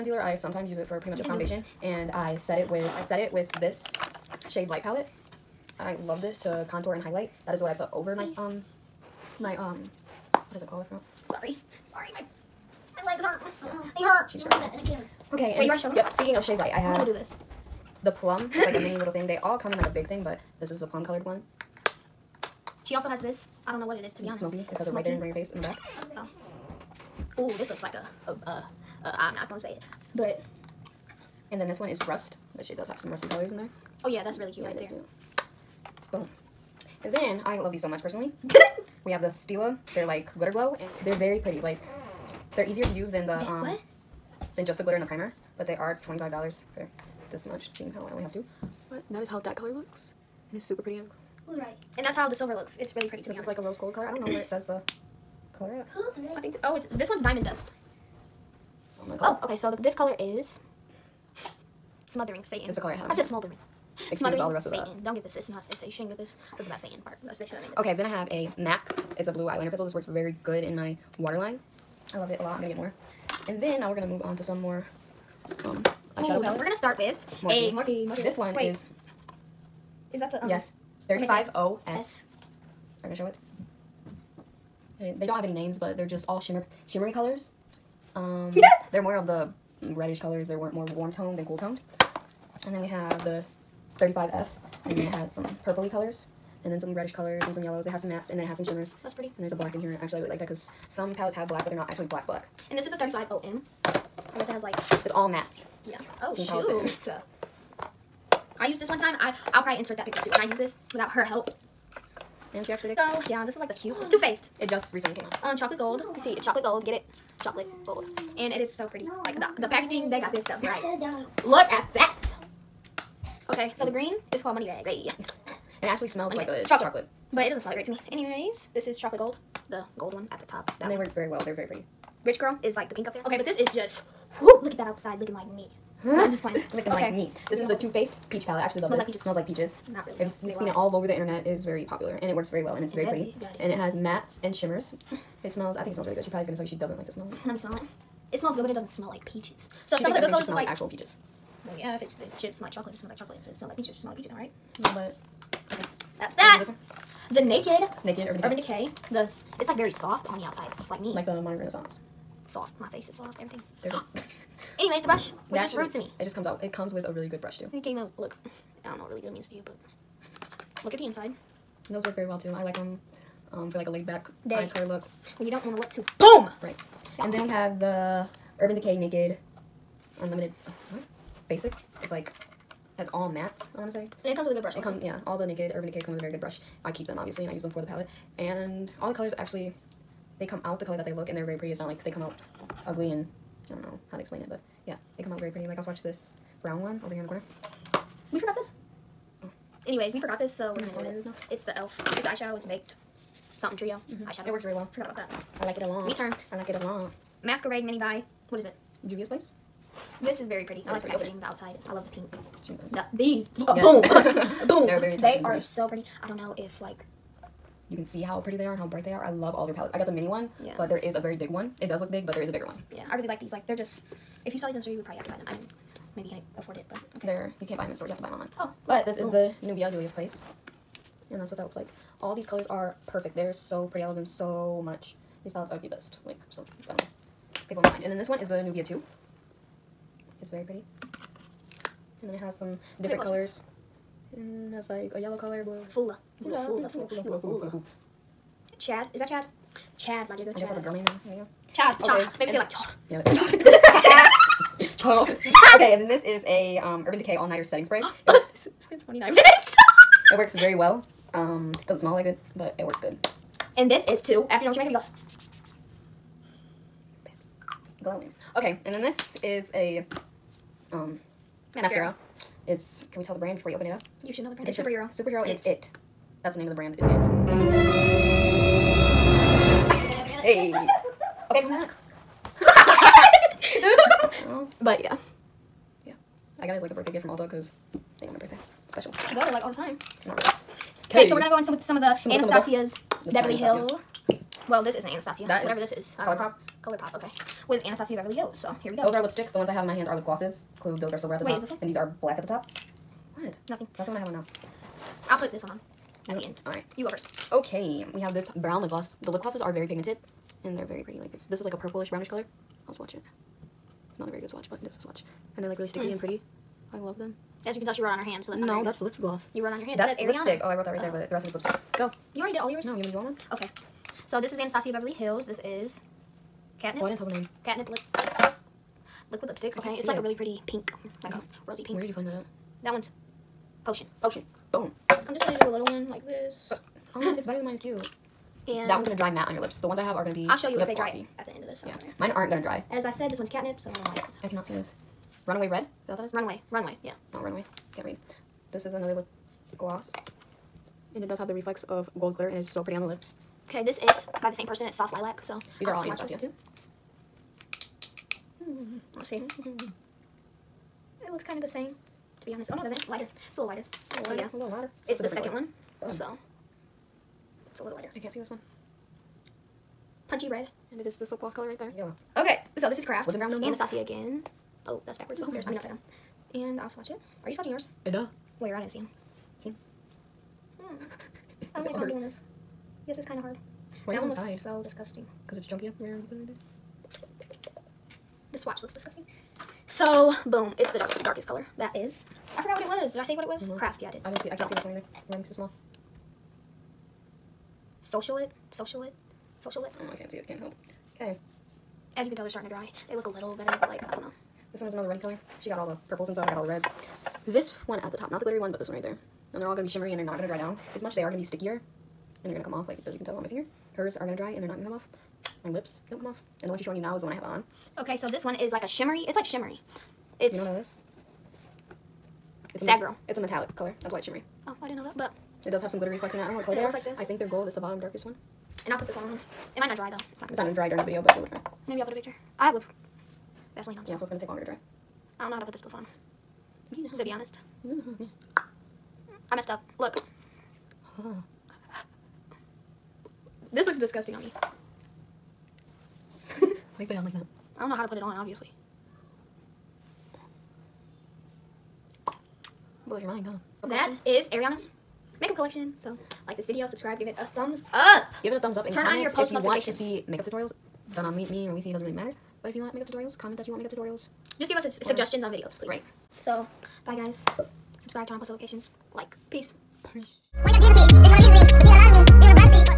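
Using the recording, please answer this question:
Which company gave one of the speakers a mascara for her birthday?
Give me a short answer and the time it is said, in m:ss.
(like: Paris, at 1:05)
Ulta, at 4:47.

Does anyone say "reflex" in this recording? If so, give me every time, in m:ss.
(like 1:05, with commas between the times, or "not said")
5:51, 7:06.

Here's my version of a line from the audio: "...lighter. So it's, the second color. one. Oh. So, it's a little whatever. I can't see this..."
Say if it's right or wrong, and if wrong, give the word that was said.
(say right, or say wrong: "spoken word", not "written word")
wrong: "lighter", not "whatever".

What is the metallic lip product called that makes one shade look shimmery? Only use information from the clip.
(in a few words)
Sad Girl.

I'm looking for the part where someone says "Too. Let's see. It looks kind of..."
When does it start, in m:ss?
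5:56.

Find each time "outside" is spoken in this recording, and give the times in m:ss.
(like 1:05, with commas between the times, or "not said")
2:14, 2:40, 3:31.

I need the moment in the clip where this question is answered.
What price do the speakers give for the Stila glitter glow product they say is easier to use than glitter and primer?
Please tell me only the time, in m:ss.
0:46.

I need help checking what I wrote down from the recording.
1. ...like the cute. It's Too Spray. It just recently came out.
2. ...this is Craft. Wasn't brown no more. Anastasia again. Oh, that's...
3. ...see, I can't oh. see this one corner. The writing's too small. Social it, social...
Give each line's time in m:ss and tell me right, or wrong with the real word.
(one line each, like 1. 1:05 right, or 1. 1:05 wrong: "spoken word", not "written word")
1. 1:53 wrong: "Faced", not "Spray"
2. 6:12 right
3. 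6:34 wrong: "either", not "corner".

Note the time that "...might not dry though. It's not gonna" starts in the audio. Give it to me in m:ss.
7:09.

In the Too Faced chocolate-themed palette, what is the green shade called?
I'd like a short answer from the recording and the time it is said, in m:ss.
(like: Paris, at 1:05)
Money Bags, at 2:04.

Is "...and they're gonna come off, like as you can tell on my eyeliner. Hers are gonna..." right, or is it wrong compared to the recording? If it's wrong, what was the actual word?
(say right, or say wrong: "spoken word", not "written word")
wrong: "finger", not "eyeliner".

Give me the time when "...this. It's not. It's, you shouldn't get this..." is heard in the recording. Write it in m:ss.
1:05.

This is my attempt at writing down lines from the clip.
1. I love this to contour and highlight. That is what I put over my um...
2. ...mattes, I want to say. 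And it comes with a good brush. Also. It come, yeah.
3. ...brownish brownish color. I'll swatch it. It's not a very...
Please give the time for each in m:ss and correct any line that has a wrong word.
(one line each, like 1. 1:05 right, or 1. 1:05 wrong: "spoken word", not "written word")
1. 0:05 right
2. 3:03 right
3. 5:11 wrong: "purplish", not "brownish".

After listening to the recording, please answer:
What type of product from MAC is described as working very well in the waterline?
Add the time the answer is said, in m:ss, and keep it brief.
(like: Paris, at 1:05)
blue eyeliner pencil, at 1:09.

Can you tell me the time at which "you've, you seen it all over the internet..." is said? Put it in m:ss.
2:20.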